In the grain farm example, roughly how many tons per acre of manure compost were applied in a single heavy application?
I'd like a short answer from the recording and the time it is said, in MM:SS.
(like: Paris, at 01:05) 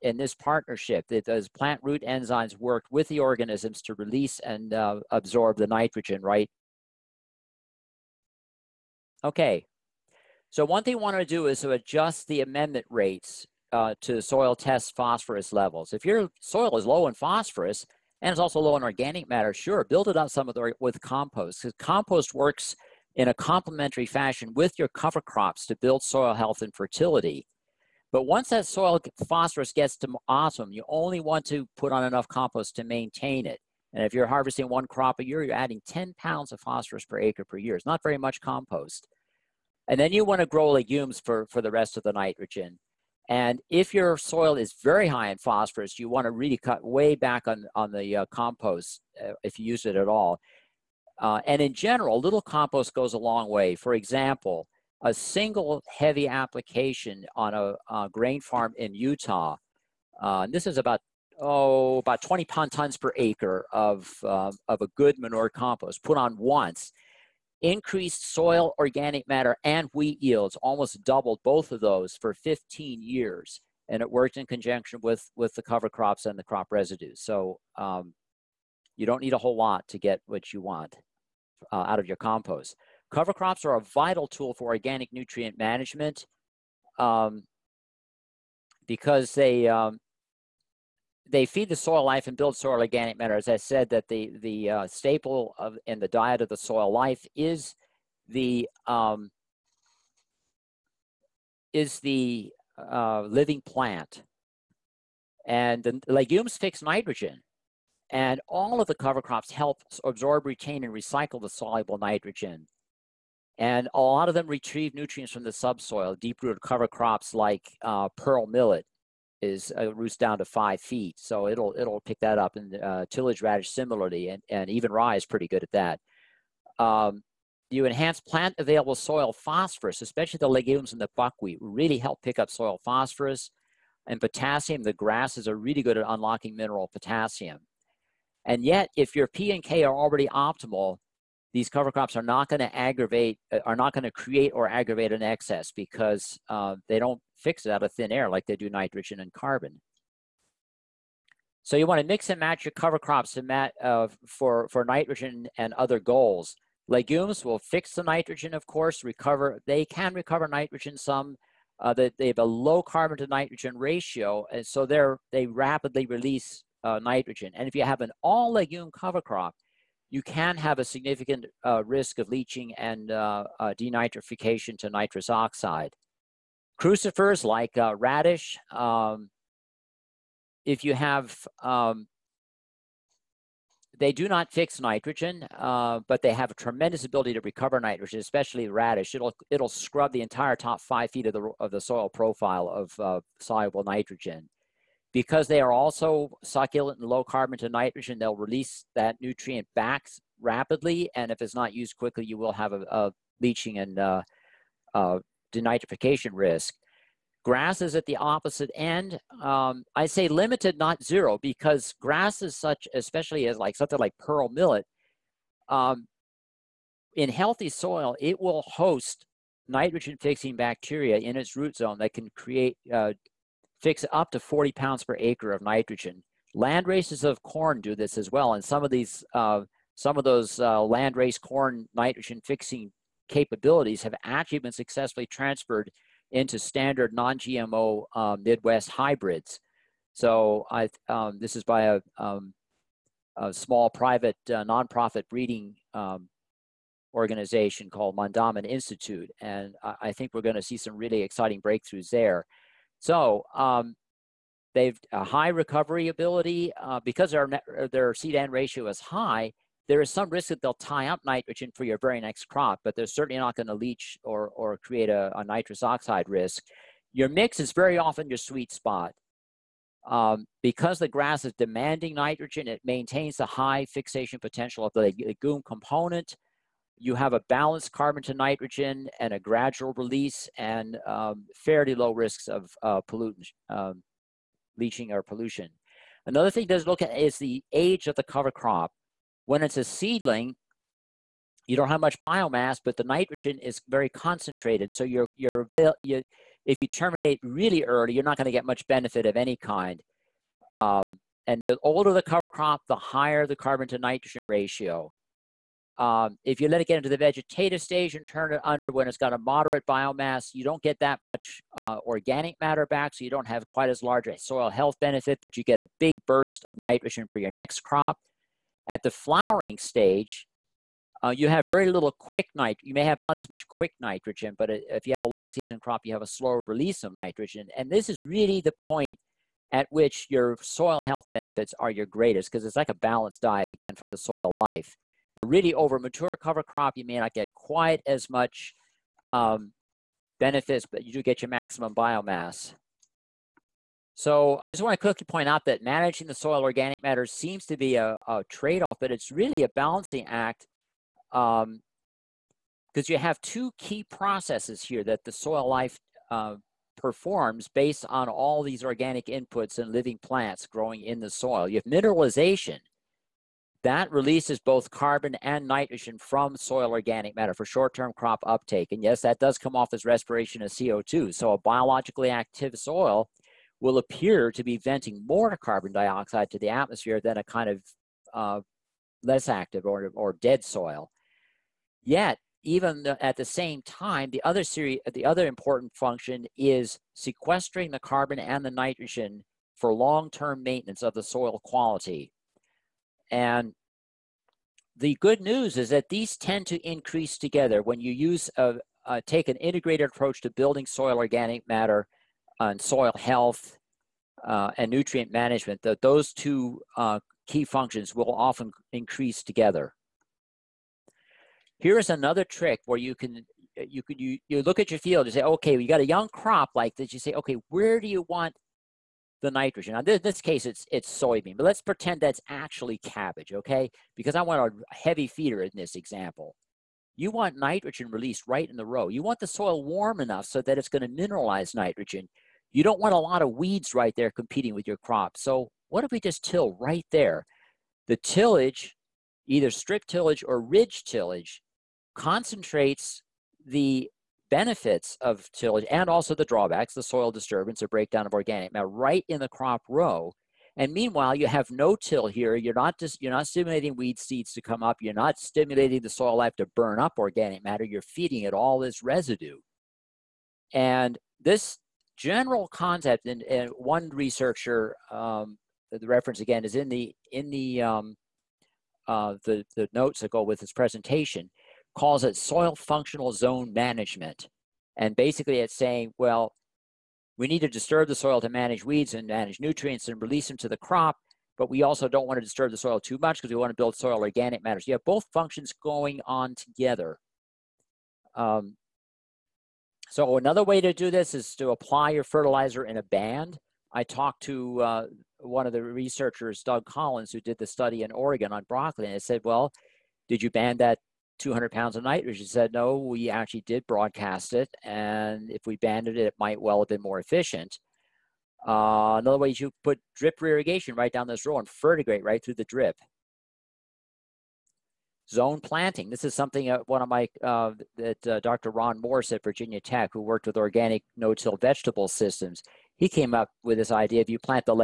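20 tons, at 01:02.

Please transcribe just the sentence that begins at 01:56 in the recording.
Deep-rooted cover crops like uh, pearl millet is uh, roots down to five feet, so it'll it'll pick that up.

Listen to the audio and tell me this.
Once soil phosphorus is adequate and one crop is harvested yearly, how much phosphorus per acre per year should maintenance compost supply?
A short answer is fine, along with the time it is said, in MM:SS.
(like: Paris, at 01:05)
10 pounds, at 00:35.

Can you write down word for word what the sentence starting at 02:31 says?
So you want to mix and match your cover crops mat, uh, for, for nitrogen and other goals.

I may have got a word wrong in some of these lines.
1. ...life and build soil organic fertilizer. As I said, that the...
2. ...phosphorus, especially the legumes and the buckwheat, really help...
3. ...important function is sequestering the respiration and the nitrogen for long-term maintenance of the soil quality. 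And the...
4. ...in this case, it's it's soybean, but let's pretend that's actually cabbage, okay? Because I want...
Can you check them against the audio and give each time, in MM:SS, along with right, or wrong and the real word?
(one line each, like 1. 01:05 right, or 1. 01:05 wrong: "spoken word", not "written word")
1. 01:32 wrong: "matter", not "fertilizer"
2. 02:09 right
3. 06:25 wrong: "carbon", not "respiration"
4. 07:00 right.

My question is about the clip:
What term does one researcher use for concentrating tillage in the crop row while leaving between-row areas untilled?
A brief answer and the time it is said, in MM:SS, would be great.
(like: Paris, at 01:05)
Soil functional zone management, at 07:52.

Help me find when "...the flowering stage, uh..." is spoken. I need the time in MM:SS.
05:19.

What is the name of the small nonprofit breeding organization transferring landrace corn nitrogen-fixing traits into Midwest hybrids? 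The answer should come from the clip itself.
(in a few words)
Mandaamin Institute.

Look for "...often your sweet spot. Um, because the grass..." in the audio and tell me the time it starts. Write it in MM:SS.
04:27.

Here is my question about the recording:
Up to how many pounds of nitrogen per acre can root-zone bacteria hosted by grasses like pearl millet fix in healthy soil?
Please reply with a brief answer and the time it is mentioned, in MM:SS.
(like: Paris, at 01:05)
40 pounds, at 03:44.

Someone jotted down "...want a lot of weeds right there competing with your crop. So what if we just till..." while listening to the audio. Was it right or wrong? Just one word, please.
right.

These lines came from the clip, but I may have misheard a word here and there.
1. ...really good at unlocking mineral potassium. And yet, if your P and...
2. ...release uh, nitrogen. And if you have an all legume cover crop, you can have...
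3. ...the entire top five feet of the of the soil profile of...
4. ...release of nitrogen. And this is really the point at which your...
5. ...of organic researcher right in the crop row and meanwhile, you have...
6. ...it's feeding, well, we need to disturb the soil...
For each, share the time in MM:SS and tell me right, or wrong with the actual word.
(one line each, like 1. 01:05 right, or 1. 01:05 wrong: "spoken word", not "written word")
1. 02:15 right
2. 02:46 right
3. 03:10 right
4. 05:26 right
5. 07:28 wrong: "matter", not "researcher"
6. 07:55 wrong: "saying", not "feeding".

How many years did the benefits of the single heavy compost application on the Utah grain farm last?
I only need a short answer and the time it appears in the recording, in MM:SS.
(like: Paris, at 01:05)
15 years, at 01:12.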